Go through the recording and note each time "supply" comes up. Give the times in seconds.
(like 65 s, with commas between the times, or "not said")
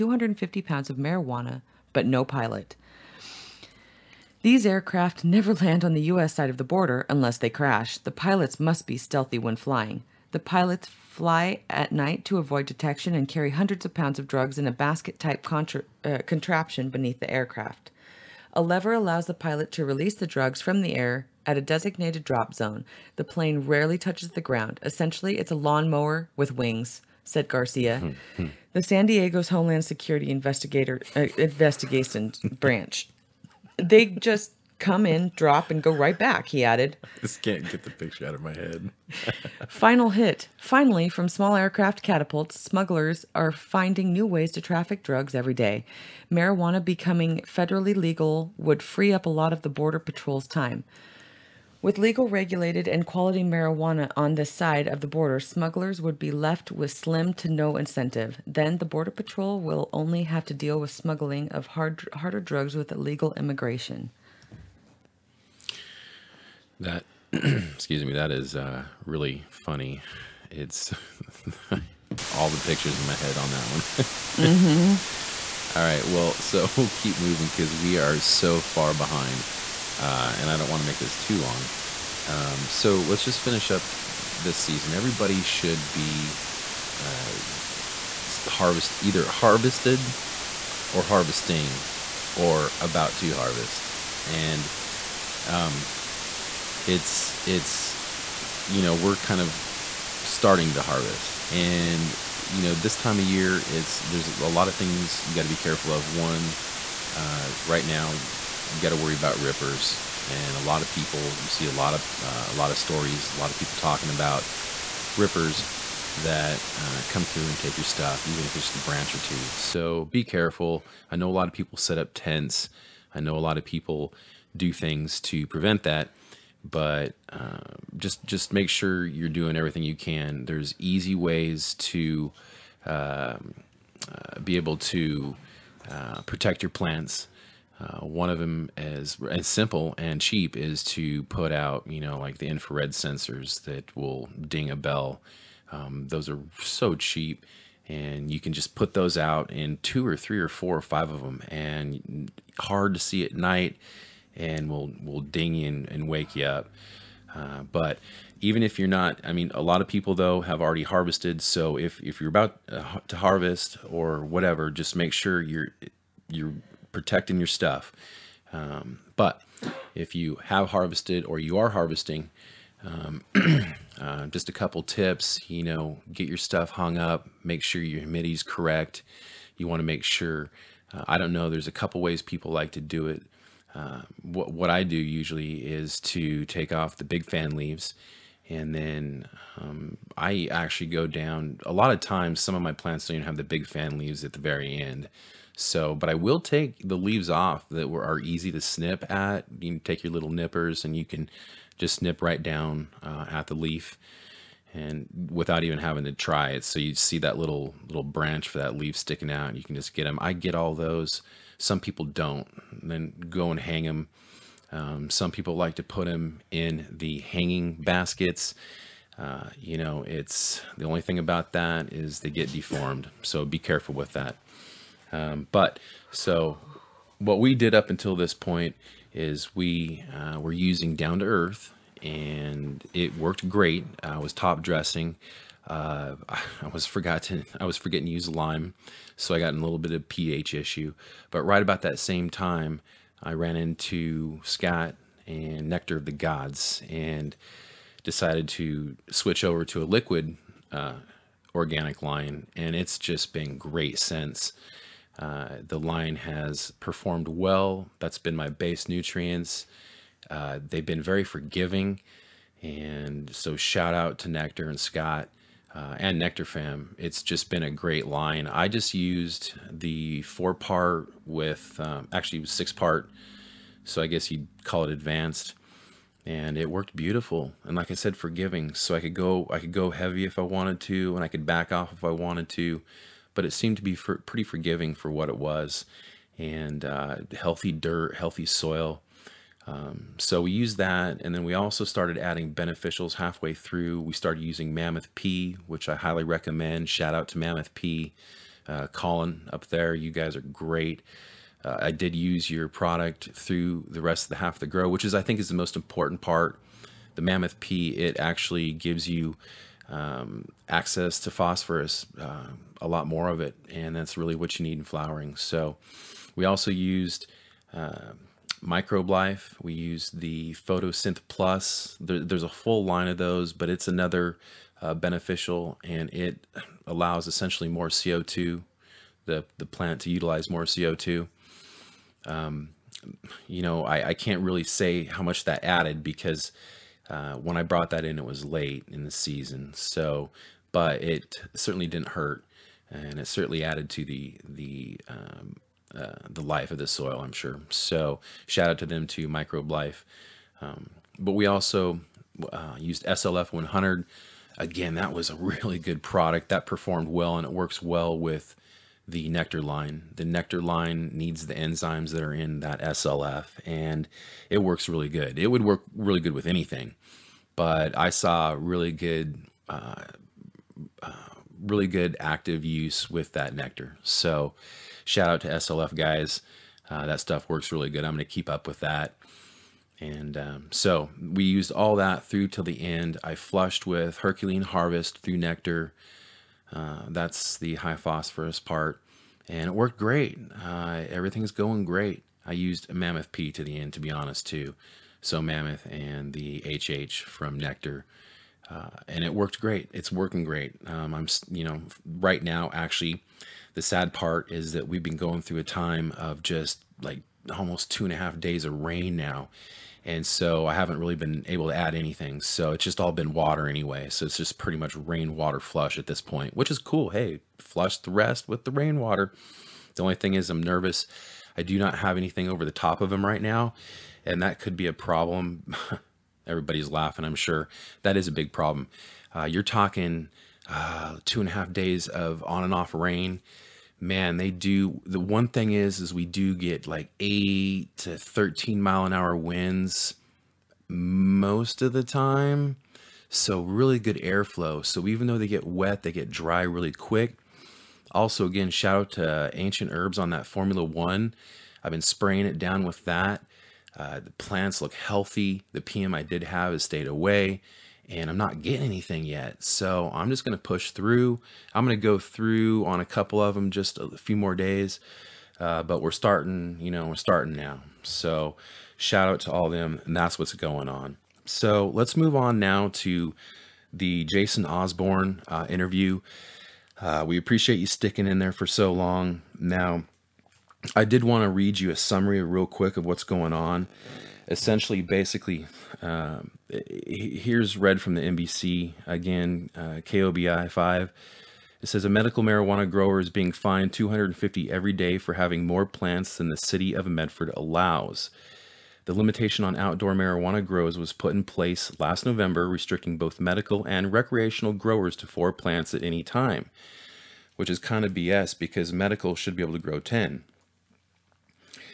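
not said.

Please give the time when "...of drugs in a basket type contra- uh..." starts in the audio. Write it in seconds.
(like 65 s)
14 s.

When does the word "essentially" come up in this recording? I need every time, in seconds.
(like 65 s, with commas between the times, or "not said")
24 s, 327 s, 484 s.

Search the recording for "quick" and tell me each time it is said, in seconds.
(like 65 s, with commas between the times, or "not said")
446 s, 482 s.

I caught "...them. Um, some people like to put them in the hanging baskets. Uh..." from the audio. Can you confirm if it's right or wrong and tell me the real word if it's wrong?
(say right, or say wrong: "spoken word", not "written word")
right.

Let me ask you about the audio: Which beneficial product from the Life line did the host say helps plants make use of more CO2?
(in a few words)
Photosynth Plus.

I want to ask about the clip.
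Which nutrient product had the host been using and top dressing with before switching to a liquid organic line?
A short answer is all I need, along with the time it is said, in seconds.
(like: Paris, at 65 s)
Down to Earth, at 230 s.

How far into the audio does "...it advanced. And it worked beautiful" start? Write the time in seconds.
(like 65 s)
274 s.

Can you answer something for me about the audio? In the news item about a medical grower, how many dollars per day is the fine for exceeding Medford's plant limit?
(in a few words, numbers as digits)
250.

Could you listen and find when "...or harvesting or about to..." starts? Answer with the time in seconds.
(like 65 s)
90 s.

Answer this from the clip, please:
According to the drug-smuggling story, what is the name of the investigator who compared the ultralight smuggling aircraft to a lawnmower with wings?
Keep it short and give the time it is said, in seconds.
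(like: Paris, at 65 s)
Garcia, at 27 s.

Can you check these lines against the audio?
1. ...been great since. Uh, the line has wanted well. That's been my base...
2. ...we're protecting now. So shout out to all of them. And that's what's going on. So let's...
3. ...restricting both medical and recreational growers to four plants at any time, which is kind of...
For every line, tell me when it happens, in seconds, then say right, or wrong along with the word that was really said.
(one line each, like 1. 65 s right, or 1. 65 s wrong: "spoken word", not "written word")
1. 253 s wrong: "performed", not "wanted"
2. 467 s wrong: "starting", not "protecting"
3. 502 s right.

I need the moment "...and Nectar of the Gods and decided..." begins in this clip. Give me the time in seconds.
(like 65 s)
245 s.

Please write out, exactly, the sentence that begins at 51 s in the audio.
With legal regulated and quality marijuana on this side of the border, smugglers would be left with slim to no incentive.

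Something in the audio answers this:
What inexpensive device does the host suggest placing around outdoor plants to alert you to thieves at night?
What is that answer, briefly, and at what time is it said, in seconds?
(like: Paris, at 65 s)
infrared sensors, at 142 s.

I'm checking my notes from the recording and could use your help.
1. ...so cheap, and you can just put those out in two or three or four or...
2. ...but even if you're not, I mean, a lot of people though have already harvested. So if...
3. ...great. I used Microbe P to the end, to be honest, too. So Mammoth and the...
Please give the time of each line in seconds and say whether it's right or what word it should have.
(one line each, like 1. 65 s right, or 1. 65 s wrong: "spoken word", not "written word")
1. 146 s right
2. 157 s right
3. 391 s wrong: "Mammoth", not "Microbe".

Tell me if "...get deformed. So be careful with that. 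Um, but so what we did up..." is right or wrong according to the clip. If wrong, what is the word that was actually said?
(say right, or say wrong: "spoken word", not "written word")
right.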